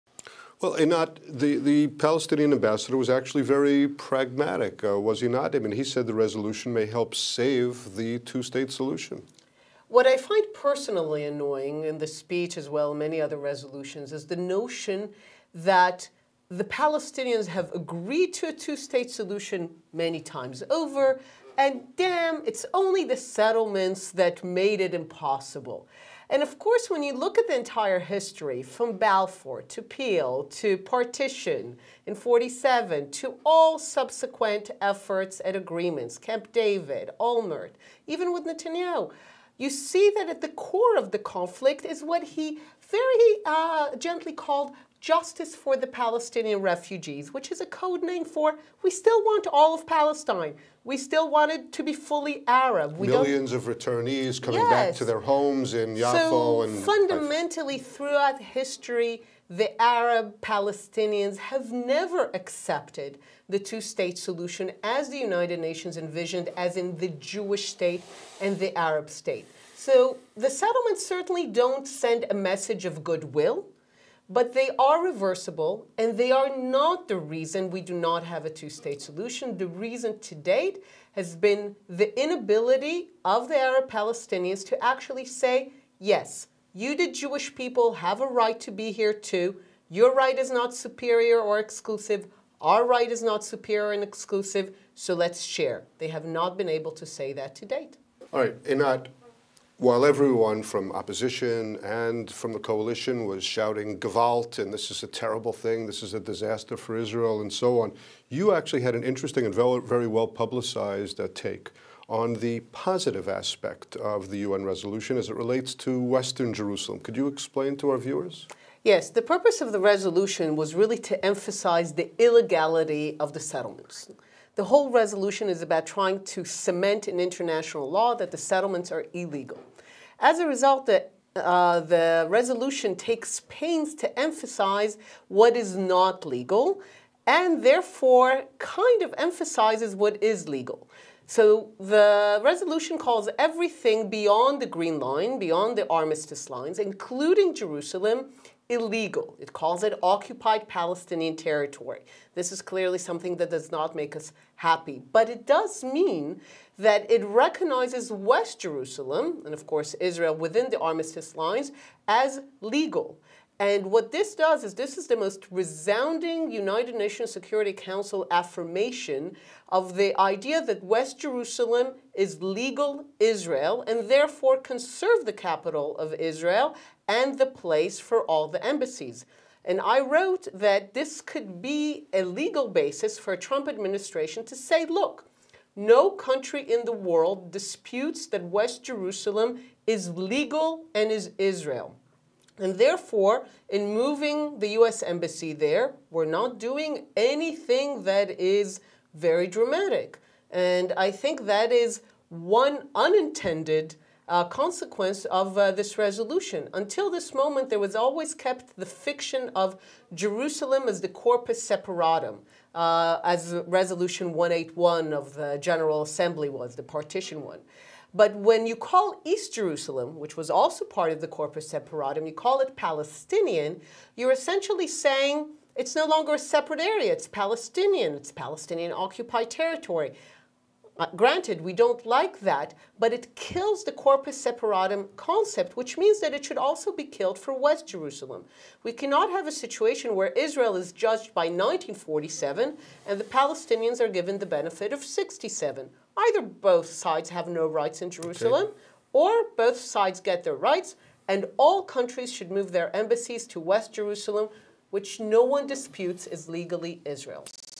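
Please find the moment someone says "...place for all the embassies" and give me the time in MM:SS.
02:57.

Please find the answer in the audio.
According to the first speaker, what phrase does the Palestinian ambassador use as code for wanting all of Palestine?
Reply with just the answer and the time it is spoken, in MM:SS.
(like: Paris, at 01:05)
justice for the Palestinian refugees, at 00:44.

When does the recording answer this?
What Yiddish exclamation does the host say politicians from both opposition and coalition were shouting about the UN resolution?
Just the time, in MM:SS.
01:43.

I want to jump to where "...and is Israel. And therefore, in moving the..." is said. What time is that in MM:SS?
03:10.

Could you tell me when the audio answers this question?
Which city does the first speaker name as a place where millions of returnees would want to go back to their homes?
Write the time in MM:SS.
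00:55.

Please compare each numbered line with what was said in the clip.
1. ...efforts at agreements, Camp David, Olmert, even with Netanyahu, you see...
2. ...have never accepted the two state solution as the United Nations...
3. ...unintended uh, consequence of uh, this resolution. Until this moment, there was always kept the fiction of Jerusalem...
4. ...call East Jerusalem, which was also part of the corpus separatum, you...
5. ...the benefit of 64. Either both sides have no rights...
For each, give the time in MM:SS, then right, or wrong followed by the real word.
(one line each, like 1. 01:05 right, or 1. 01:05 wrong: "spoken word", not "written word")
1. 00:34 right
2. 01:01 right
3. 03:22 right
4. 03:38 right
5. 04:04 wrong: "67", not "64".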